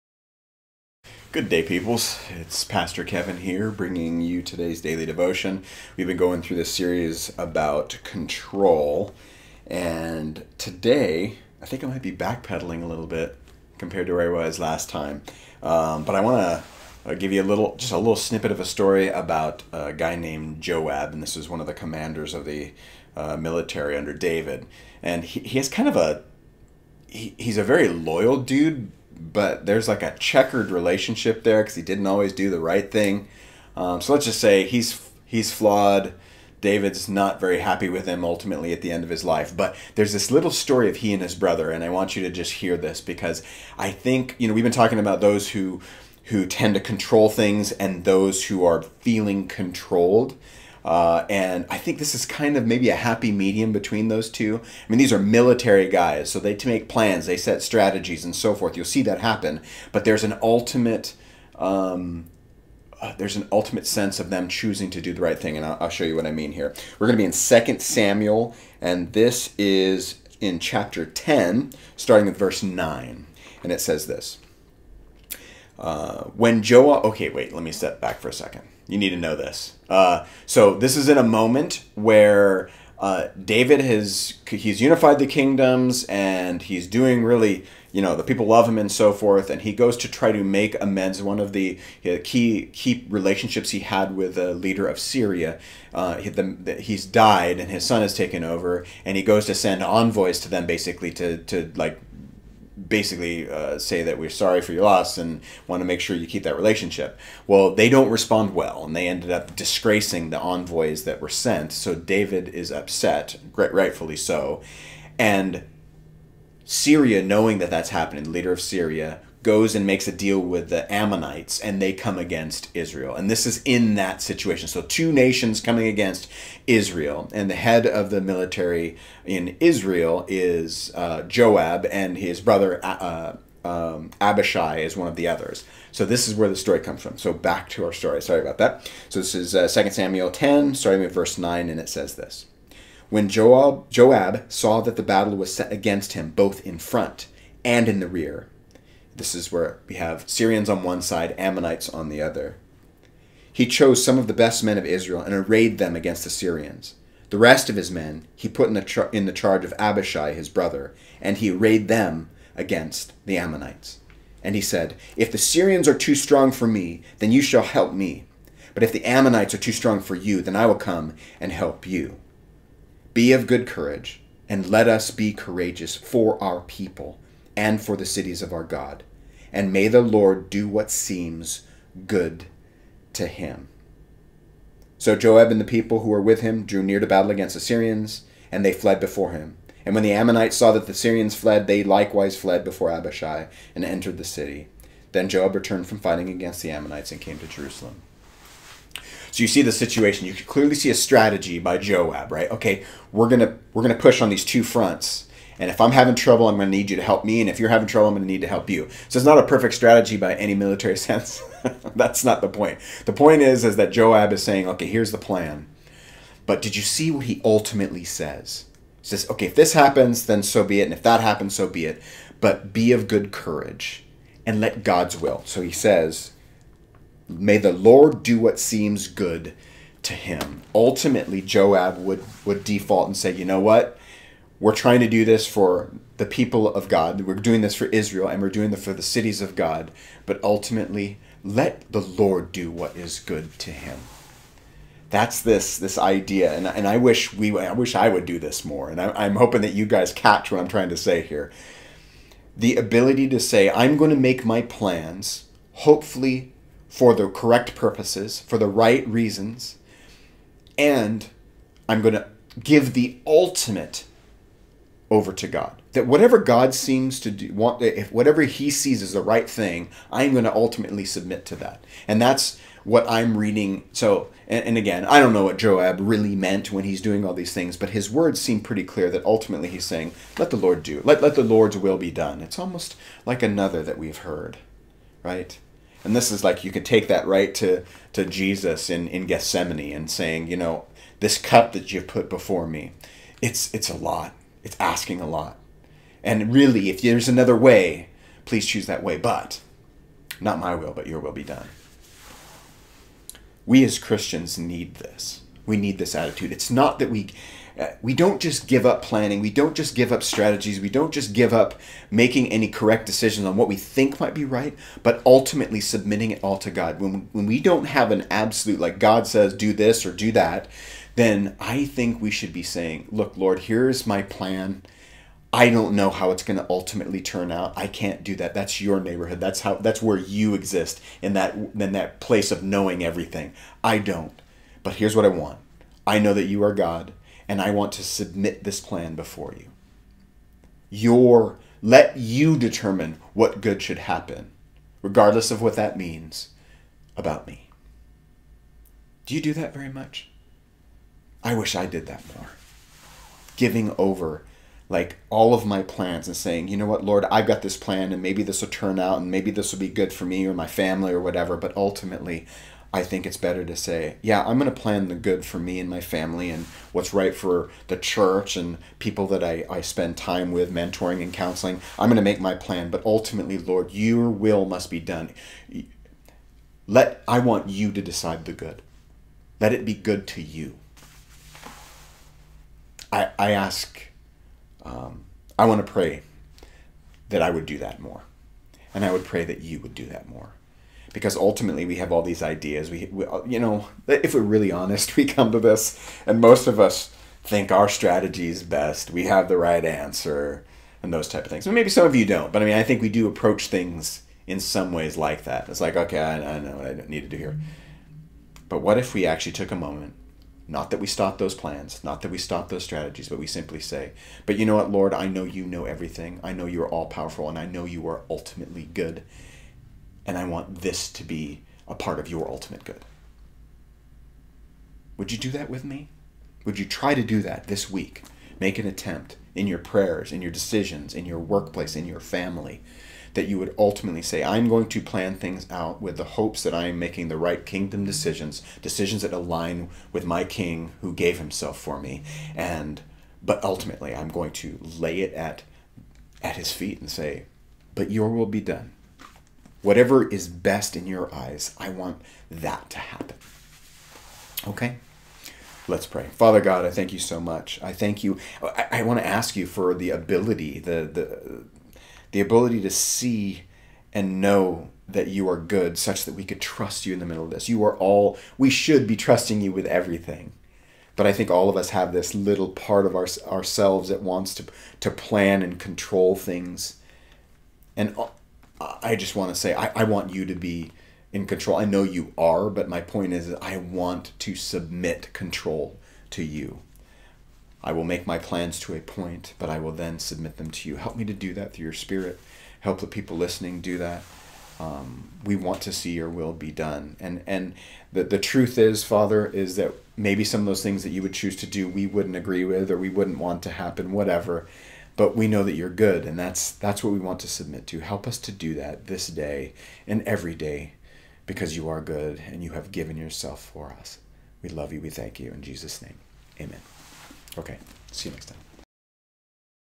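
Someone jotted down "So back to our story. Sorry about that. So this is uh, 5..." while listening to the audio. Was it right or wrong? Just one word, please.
wrong.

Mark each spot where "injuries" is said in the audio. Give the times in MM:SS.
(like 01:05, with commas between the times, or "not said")
not said.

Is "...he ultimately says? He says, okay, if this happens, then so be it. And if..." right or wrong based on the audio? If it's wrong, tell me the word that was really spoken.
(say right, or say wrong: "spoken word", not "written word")
right.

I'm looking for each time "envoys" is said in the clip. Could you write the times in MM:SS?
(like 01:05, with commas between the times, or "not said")
01:39, 01:50.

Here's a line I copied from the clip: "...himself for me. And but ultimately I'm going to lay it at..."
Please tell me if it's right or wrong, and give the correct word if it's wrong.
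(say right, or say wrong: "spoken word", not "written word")
right.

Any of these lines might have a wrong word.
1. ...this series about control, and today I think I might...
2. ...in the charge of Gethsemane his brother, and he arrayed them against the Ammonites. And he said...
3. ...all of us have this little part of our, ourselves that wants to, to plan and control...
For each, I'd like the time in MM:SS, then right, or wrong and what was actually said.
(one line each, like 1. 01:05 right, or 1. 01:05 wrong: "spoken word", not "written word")
1. 00:06 right
2. 02:39 wrong: "Abishai", not "Gethsemane"
3. 07:51 right.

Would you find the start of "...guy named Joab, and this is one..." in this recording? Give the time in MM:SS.
00:19.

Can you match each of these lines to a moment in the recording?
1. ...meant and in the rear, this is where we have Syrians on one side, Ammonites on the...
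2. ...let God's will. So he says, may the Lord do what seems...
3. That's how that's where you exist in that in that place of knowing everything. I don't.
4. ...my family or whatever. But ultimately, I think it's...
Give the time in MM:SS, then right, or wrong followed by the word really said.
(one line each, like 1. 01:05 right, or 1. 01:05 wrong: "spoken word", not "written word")
1. 02:26 wrong: "front", not "meant"
2. 03:44 right
3. 05:29 right
4. 06:00 right.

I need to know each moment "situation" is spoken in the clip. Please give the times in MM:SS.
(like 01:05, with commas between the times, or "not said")
02:04, 03:19.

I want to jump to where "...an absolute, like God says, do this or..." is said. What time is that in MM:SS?
05:18.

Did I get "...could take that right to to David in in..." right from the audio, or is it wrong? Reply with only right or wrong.
wrong.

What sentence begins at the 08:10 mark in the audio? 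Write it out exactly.
Help me to do that through your spirit.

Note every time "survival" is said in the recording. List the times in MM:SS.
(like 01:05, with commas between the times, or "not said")
not said.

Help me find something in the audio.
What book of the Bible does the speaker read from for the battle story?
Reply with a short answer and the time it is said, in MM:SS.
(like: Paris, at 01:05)
Second Samuel, at 01:07.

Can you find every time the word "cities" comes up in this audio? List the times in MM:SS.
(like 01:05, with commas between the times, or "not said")
02:58, 03:59.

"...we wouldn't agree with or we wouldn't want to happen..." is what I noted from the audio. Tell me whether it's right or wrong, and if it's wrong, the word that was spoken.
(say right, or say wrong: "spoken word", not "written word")
right.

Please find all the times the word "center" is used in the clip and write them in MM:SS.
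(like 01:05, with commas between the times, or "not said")
not said.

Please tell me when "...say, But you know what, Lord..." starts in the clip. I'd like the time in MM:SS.
06:53.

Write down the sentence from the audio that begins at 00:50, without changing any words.
Uh, and I think this is kind of maybe a happy medium between those two.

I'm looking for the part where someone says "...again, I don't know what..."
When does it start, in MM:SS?
04:34.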